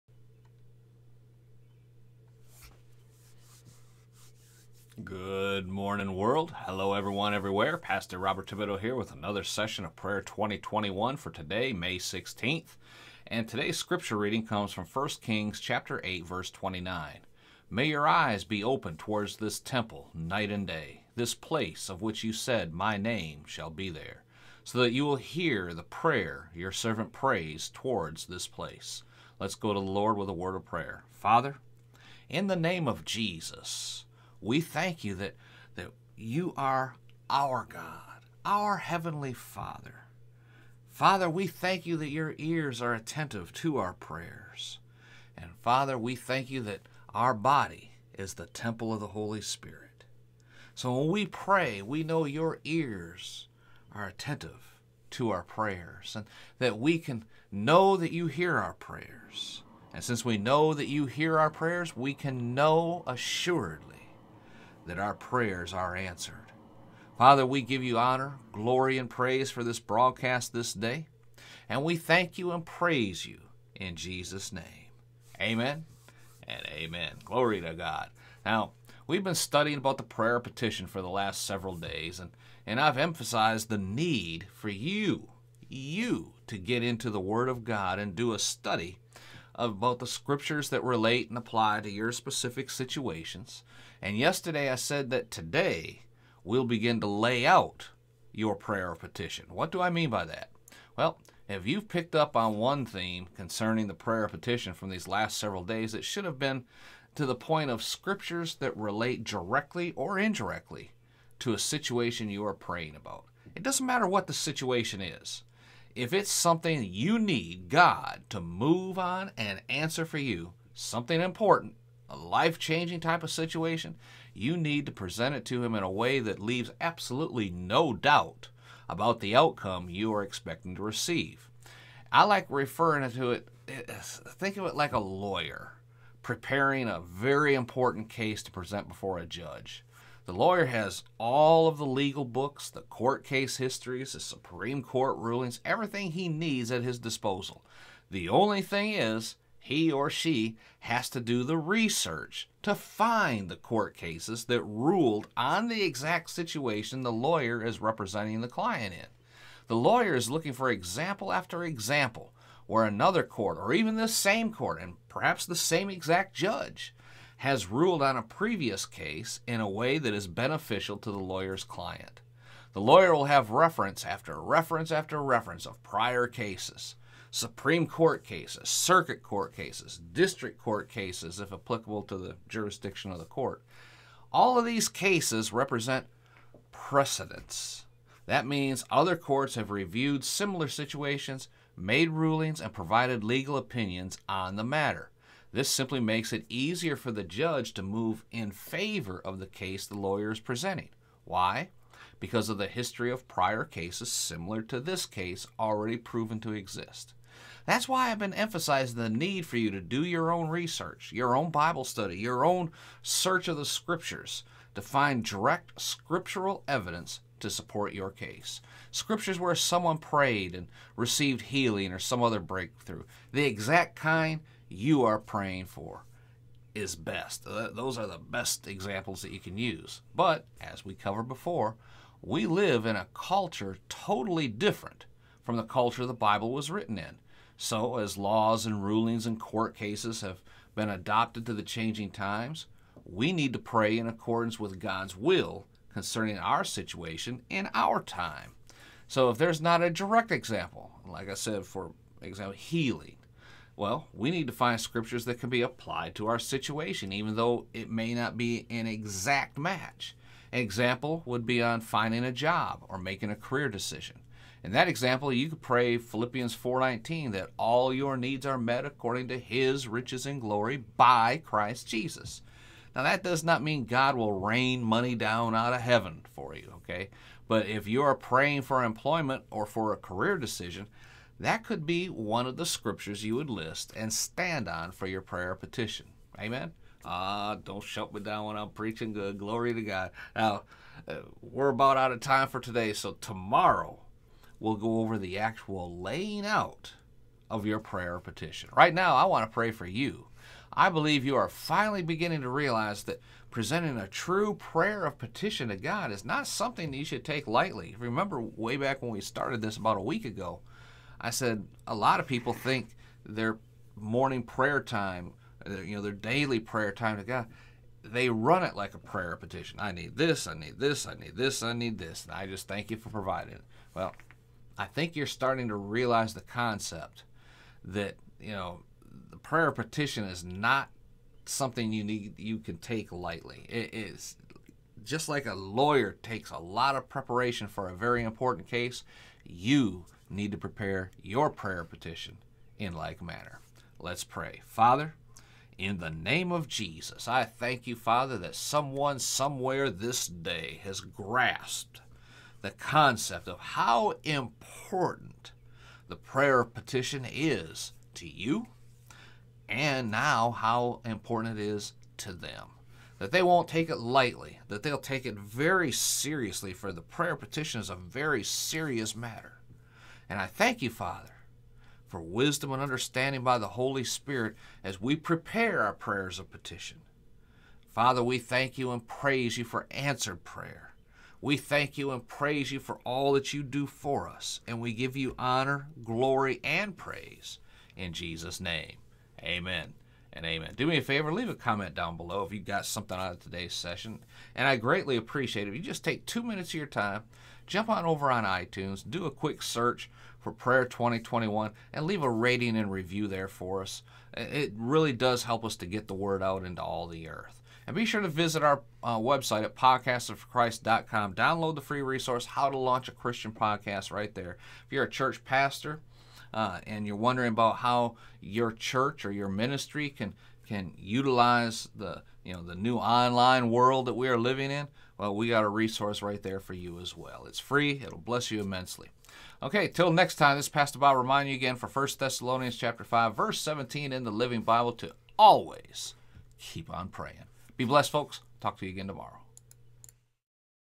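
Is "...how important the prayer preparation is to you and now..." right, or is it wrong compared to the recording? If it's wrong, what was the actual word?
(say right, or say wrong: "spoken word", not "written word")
wrong: "petition", not "preparation".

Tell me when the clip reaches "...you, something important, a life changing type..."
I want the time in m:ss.
2:00.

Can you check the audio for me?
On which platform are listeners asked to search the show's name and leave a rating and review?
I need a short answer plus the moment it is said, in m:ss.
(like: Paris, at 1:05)
iTunes, at 6:38.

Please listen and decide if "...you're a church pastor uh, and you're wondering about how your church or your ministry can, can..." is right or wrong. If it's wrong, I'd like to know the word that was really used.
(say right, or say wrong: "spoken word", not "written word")
right.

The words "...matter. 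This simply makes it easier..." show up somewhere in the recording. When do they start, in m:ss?
3:14.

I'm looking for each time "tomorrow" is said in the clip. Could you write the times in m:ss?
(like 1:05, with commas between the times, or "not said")
4:53, 7:19.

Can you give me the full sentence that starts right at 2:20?
The lawyer has all of the legal books, the court case histories, the Supreme Court rulings, everything he needs at his disposal.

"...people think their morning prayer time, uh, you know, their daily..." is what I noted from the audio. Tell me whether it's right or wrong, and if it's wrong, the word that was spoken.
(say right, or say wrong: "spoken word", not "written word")
right.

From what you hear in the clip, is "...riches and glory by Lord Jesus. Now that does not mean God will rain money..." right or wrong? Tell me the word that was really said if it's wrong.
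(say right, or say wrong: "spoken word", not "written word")
wrong: "Christ", not "Lord".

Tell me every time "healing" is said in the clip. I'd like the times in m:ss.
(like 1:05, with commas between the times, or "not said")
3:41, 4:12.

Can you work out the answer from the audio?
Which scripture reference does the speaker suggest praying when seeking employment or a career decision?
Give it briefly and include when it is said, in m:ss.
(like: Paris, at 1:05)
Philippians 4:19, at 4:25.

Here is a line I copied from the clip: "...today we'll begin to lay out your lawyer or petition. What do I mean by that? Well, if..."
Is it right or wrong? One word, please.
wrong.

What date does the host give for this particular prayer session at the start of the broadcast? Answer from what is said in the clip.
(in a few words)
May 16th.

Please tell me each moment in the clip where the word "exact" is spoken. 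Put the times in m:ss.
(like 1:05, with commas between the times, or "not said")
2:35, 2:45, 3:43, 4:18.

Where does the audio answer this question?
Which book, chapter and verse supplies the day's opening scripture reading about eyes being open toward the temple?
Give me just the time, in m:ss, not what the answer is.
0:14.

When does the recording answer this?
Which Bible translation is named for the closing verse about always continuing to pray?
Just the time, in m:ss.
7:14.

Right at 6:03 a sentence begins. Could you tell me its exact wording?
That they won't take it lightly, that they'll take it very seriously, for the prayer petition is a very serious matter.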